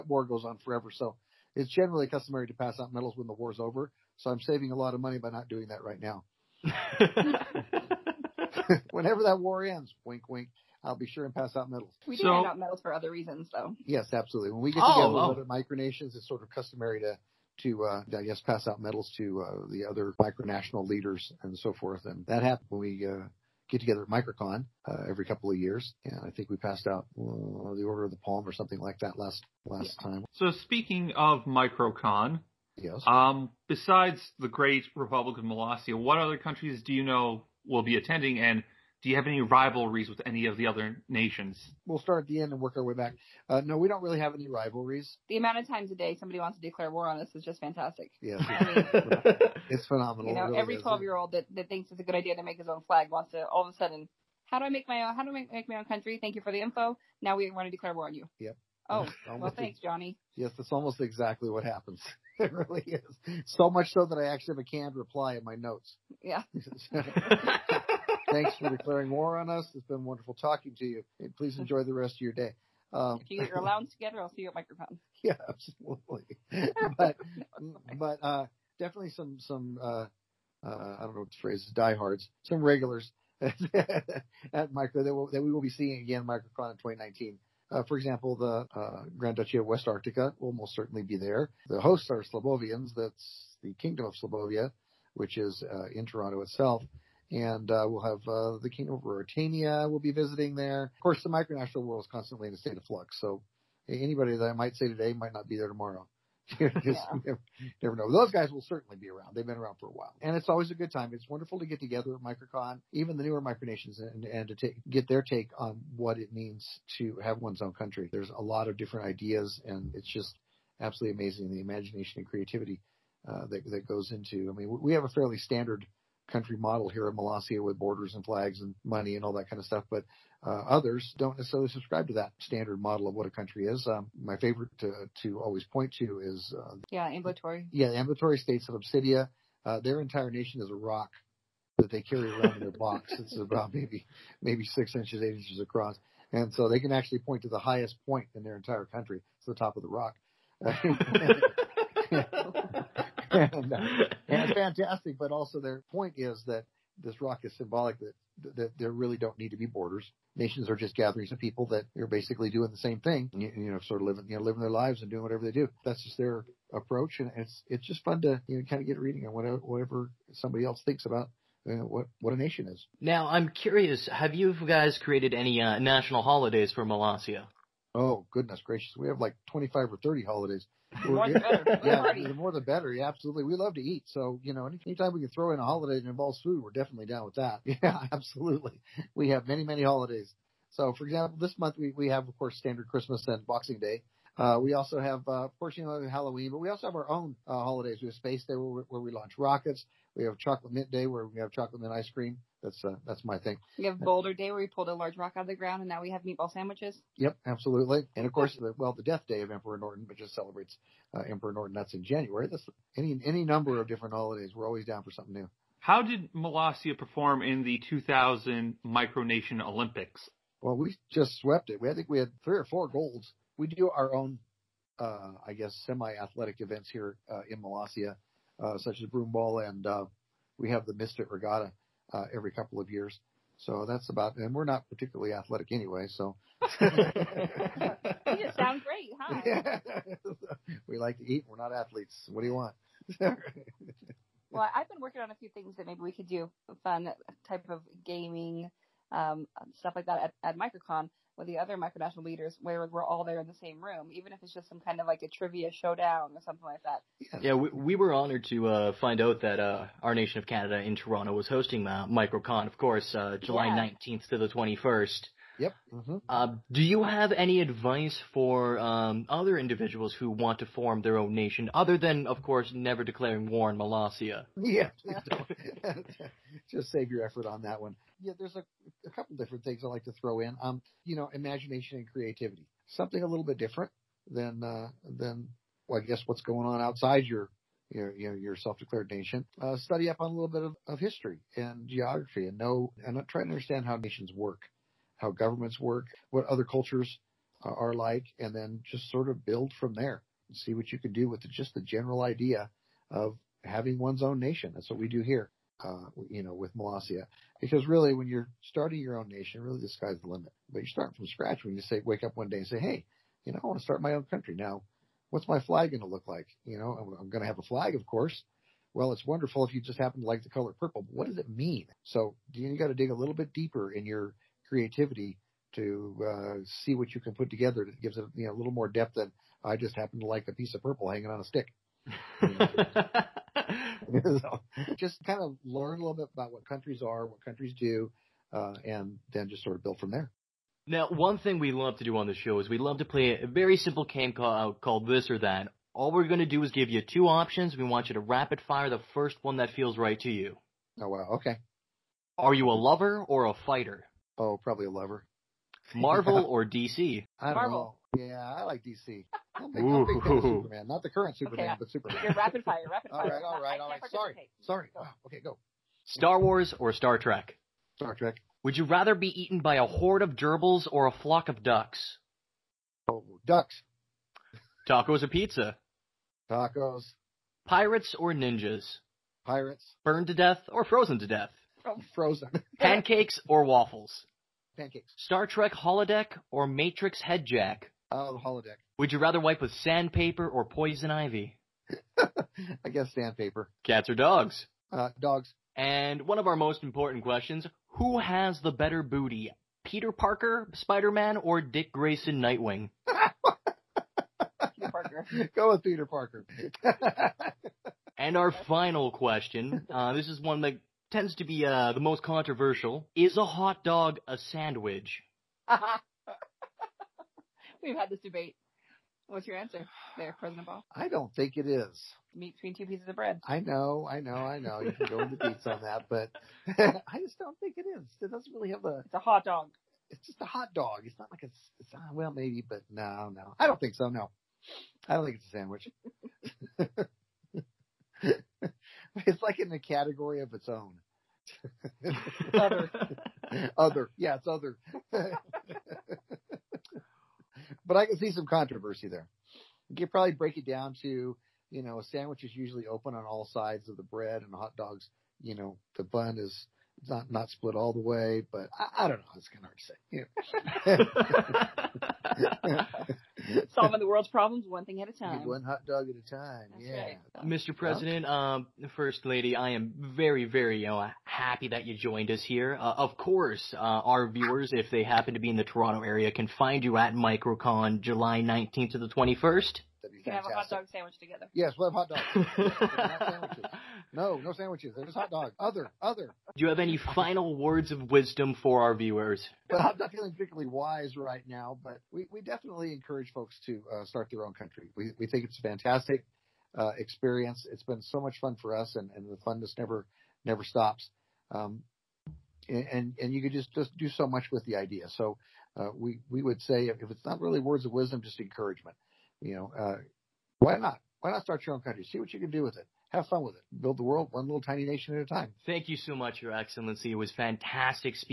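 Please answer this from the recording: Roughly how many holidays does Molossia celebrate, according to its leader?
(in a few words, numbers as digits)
25 or 30.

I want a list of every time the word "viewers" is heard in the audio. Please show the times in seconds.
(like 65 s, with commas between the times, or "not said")
474 s, 488 s.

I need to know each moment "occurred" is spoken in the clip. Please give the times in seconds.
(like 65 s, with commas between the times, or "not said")
not said.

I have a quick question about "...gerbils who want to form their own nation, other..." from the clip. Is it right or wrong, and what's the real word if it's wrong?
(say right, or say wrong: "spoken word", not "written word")
wrong: "individuals", not "gerbils".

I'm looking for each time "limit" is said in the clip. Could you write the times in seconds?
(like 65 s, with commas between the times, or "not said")
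310 s.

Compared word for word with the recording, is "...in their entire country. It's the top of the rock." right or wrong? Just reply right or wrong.
right.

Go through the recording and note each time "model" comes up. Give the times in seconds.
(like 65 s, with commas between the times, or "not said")
126 s, 132 s.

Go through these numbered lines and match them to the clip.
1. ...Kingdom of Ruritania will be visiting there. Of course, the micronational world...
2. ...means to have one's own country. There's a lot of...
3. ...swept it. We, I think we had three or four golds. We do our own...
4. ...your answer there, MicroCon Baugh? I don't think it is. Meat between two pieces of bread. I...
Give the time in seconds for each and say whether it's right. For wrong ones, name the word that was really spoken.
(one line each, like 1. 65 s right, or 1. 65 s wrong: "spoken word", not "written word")
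1. 98 s right
2. 116 s right
3. 221 s right
4. 419 s wrong: "President", not "MicroCon".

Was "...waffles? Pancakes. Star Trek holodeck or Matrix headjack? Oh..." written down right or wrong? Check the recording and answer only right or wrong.
right.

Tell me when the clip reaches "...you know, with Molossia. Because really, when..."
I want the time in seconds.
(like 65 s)
306 s.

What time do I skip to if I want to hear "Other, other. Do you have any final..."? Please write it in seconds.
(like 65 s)
485 s.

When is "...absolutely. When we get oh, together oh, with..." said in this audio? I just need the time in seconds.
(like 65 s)
14 s.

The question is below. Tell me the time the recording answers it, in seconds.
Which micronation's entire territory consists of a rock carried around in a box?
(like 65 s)
138 s.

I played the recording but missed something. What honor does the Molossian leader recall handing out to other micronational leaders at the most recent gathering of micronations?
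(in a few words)
Order of the Palm.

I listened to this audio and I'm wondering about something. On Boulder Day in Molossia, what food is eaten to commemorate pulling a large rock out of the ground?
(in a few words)
Meatball sandwiches.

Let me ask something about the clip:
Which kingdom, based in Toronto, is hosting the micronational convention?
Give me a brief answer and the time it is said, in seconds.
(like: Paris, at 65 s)
Slobovia, at 93 s.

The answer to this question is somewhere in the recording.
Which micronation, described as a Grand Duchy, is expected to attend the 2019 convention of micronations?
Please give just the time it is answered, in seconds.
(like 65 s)
89 s.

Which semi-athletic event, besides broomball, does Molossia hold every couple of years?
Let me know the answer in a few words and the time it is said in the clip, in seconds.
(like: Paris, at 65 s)
Mystic Regatta, at 230 s.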